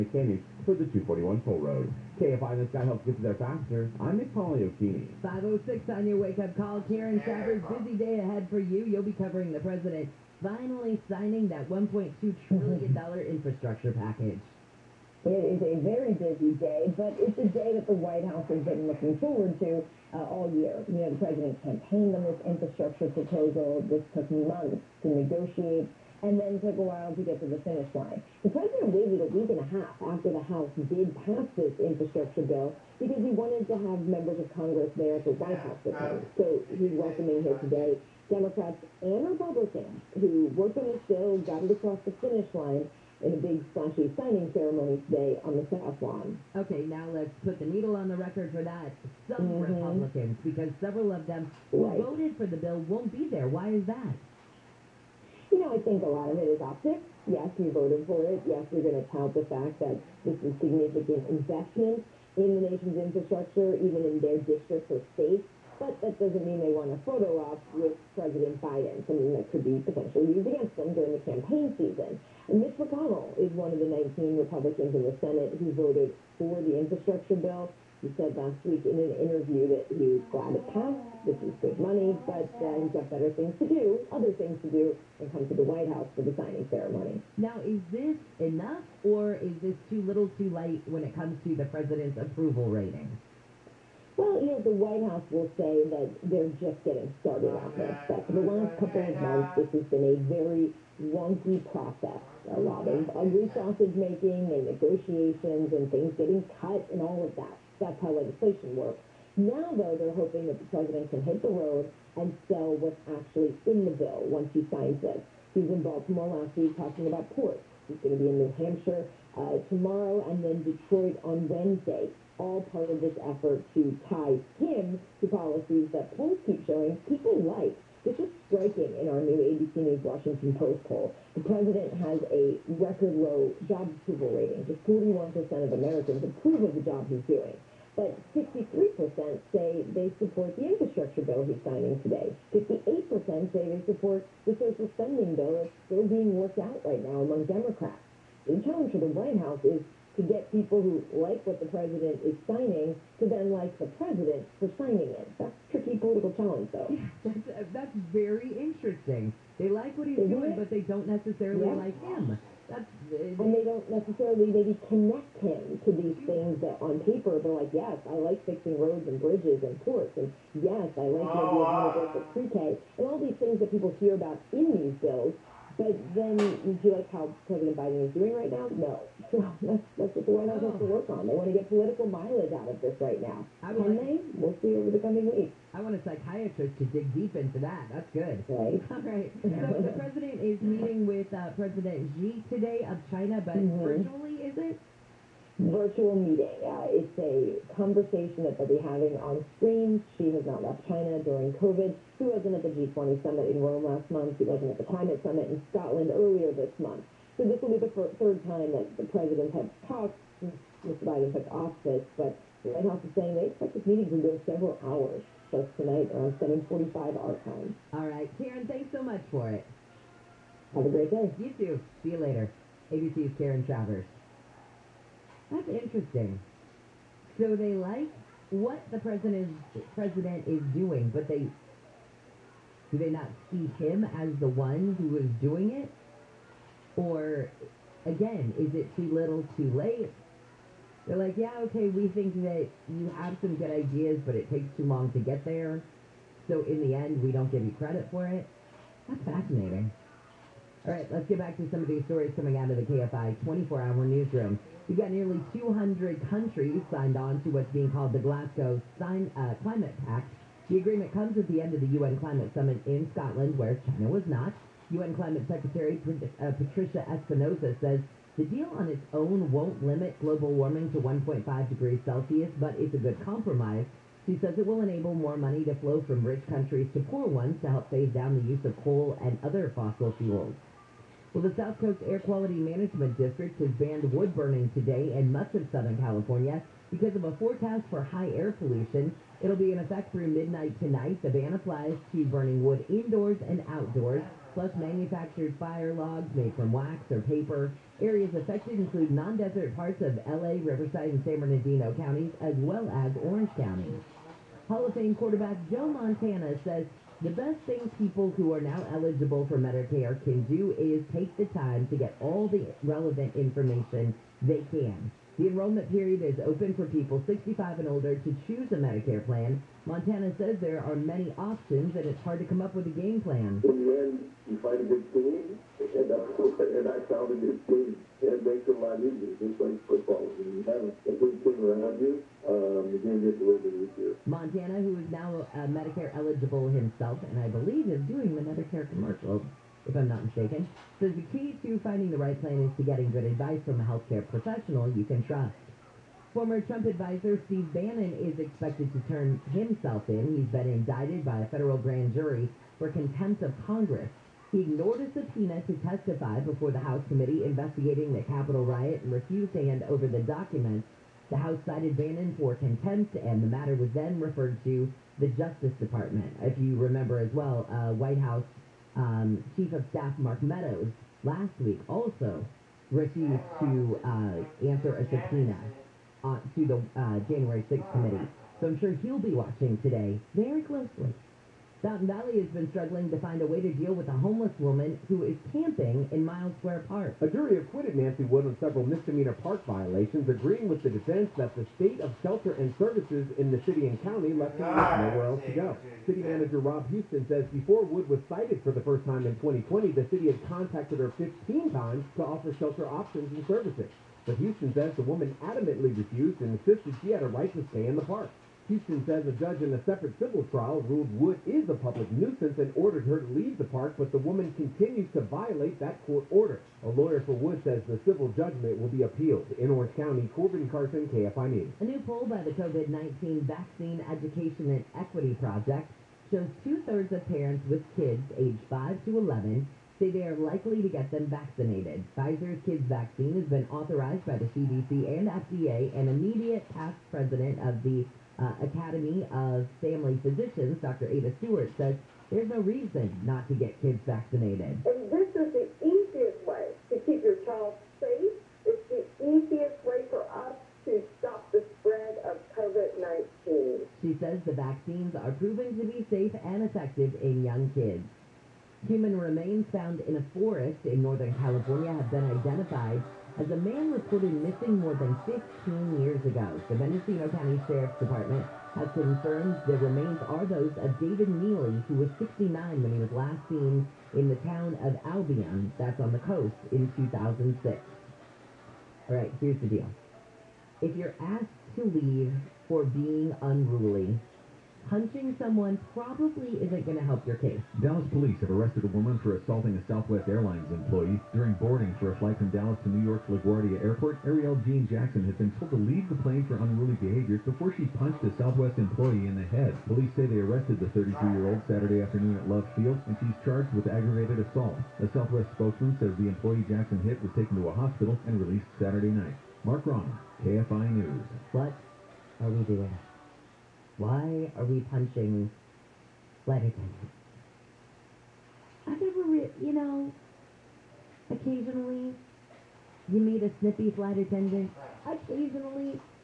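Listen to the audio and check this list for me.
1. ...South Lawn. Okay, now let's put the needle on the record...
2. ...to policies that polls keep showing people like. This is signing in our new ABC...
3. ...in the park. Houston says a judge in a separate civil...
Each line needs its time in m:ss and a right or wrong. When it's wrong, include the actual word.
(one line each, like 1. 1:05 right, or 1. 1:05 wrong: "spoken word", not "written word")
1. 0:45 right
2. 2:05 wrong: "striking", not "signing"
3. 6:47 right.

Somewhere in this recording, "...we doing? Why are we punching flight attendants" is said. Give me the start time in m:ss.
8:32.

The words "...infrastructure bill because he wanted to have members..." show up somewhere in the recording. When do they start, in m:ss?
0:31.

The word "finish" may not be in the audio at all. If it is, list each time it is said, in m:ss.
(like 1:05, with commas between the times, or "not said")
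0:27, 0:42.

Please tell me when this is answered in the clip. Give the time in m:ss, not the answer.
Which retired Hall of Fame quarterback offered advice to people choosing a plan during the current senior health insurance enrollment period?
5:05.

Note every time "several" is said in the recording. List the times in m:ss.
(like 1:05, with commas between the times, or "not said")
0:50, 3:34, 6:28.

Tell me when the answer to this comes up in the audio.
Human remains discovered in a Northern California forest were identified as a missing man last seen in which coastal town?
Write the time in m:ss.
7:55.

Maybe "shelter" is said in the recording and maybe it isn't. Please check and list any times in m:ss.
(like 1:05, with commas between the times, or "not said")
6:32, 6:42.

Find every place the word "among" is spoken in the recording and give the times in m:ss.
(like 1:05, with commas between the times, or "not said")
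2:27.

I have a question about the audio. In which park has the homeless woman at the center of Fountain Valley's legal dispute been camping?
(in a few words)
Miles Square Park.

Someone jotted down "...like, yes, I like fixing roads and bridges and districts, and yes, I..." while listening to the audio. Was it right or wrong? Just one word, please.
wrong.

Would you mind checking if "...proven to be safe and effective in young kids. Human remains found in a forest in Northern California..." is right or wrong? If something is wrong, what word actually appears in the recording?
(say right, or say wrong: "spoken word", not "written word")
right.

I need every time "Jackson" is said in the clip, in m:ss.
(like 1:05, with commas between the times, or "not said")
8:14, 8:26.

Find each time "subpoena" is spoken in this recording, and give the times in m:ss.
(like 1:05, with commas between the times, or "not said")
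5:55, 6:15.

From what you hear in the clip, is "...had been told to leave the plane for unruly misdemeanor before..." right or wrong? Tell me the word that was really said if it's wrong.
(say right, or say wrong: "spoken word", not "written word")
wrong: "behavior", not "misdemeanor".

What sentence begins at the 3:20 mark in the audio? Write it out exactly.
Xi has not left China during COVID.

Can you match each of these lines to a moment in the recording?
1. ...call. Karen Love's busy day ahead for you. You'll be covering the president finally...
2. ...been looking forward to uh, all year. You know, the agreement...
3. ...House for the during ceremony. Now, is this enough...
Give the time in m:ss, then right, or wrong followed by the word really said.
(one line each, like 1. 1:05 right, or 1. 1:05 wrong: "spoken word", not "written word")
1. 0:06 wrong: "Shaver", not "Love"
2. 0:18 wrong: "president", not "agreement"
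3. 1:25 wrong: "signing", not "during".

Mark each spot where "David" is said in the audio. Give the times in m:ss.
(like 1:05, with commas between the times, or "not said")
7:50.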